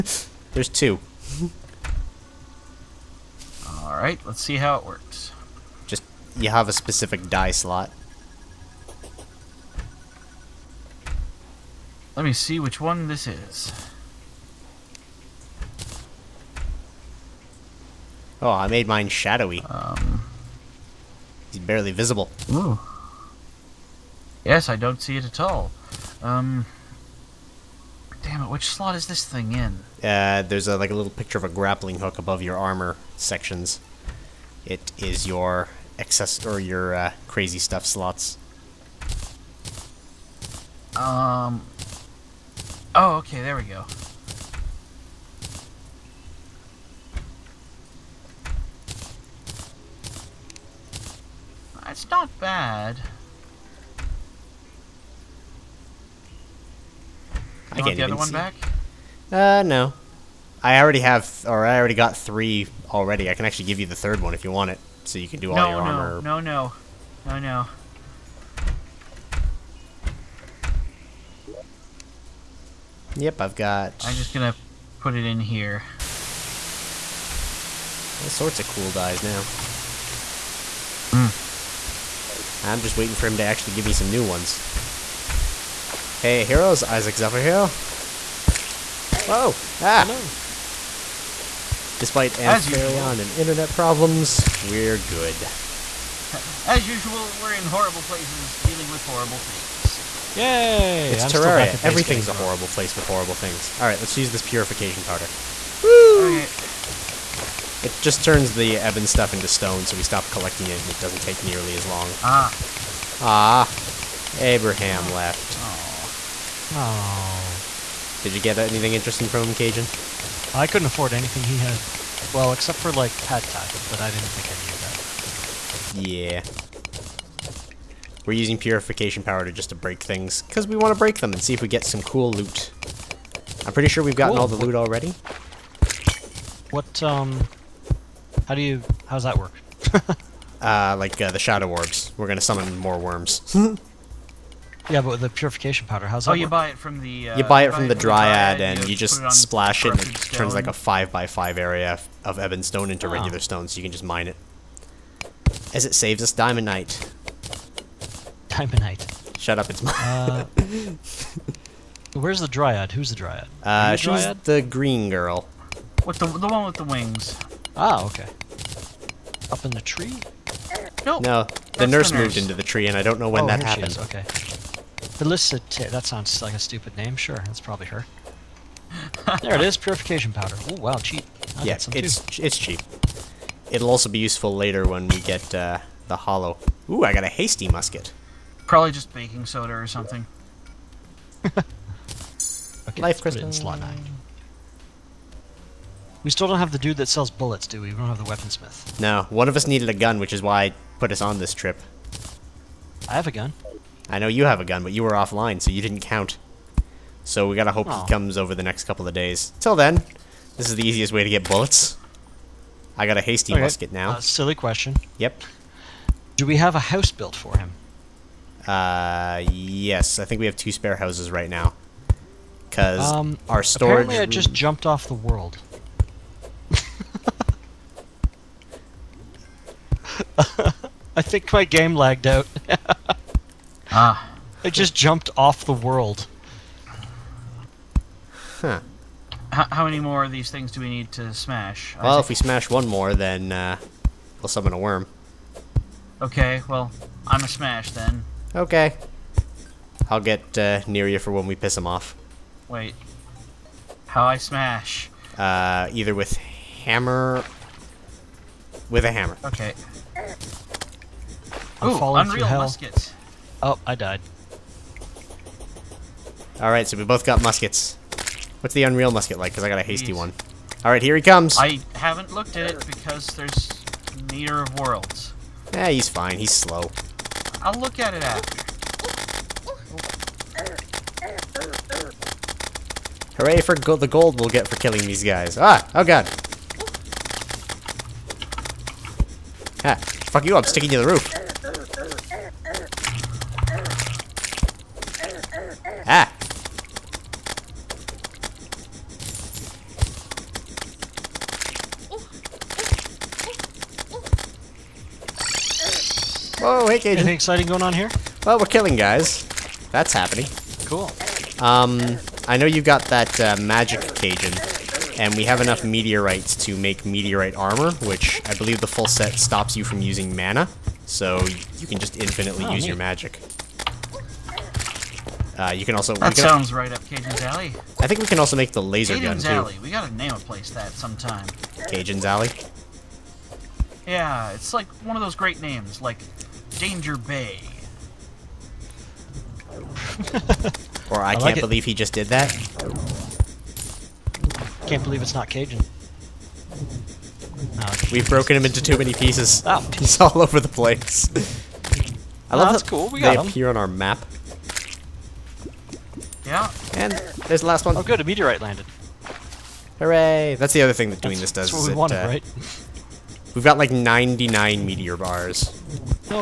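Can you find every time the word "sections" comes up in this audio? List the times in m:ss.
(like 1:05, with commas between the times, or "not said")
0:33.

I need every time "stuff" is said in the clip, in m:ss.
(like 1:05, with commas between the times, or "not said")
0:37, 1:49.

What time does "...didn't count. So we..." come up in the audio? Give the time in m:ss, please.
3:25.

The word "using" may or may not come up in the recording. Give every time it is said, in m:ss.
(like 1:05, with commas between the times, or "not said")
2:08, 5:20.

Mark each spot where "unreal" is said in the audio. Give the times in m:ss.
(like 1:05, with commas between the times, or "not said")
4:22, 4:28.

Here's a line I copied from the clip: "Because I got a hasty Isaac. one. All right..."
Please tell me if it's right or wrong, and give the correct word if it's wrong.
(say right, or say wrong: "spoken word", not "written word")
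wrong: "Jeez", not "Isaac".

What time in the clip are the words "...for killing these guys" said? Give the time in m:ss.
4:44.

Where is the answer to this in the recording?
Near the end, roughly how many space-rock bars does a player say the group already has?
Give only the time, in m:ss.
6:03.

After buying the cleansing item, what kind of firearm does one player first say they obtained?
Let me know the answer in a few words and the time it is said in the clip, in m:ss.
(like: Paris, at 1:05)
Hasty musket, at 3:07.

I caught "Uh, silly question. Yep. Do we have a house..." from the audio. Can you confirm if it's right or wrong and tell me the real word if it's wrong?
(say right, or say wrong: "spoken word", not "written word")
right.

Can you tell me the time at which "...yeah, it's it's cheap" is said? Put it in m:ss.
3:01.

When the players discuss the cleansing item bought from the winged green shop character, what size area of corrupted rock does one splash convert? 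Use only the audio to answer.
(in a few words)
5 by 5.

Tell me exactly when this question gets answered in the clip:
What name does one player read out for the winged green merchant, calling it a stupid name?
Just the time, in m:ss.
2:55.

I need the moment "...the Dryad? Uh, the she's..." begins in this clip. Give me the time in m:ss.
2:43.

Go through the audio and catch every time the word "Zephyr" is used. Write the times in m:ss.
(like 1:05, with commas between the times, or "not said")
1:27.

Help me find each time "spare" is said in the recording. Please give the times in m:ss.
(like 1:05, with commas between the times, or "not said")
3:40.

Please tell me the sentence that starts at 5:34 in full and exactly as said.
Yeah, it's like one of those great names, like Danger Bay.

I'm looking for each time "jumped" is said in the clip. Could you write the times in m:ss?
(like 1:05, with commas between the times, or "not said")
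3:44, 3:54.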